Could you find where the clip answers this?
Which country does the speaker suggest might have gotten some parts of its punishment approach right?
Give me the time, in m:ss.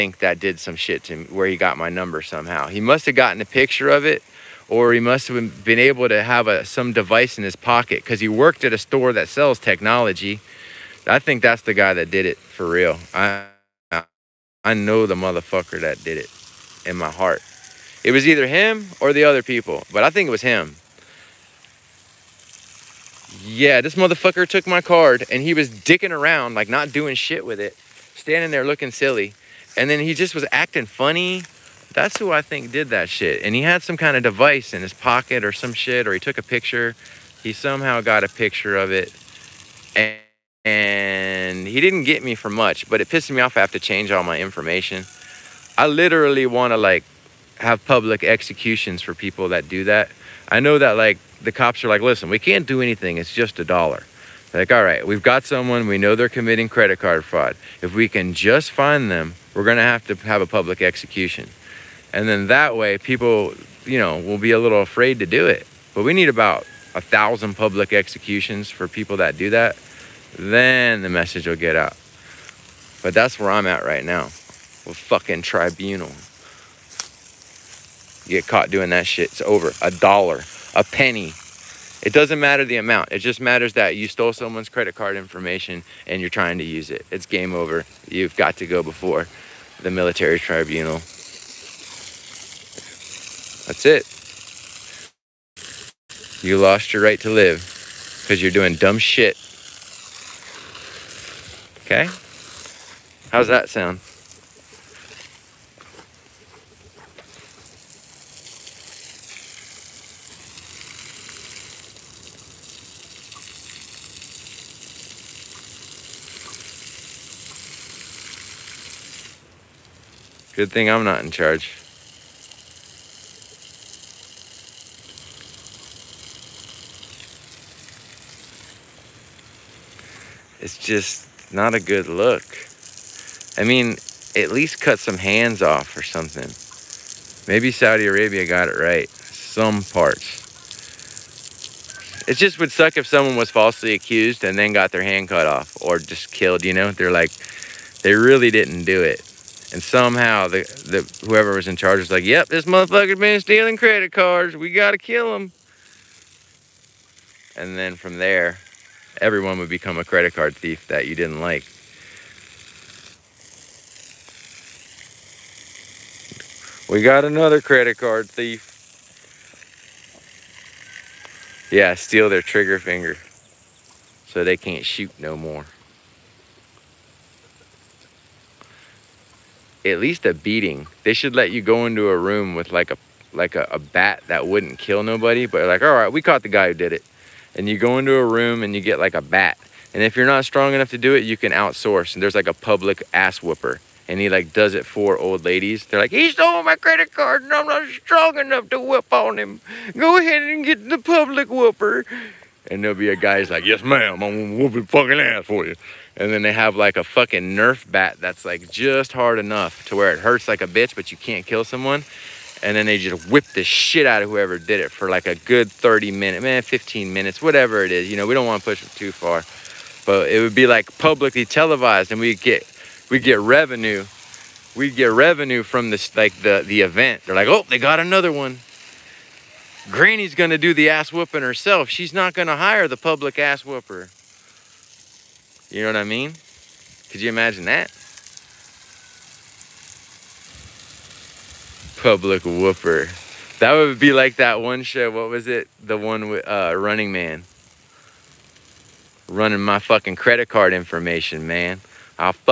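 2:17.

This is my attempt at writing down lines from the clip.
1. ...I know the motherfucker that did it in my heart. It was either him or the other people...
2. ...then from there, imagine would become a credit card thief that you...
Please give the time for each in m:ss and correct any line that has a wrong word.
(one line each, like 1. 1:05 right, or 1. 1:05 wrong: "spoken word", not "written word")
1. 0:14 right
2. 2:37 wrong: "everyone", not "imagine".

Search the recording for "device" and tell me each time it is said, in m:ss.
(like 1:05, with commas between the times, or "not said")
0:06, 0:34.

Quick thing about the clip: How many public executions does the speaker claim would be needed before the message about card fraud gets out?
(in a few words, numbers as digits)
1000.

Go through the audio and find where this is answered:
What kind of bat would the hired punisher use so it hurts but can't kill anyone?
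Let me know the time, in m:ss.
3:27.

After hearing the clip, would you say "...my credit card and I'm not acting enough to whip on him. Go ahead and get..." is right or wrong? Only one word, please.
wrong.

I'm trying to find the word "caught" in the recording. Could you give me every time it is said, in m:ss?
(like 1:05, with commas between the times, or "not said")
1:18, 3:06.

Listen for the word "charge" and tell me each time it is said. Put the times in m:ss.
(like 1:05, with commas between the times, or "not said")
2:01, 2:31.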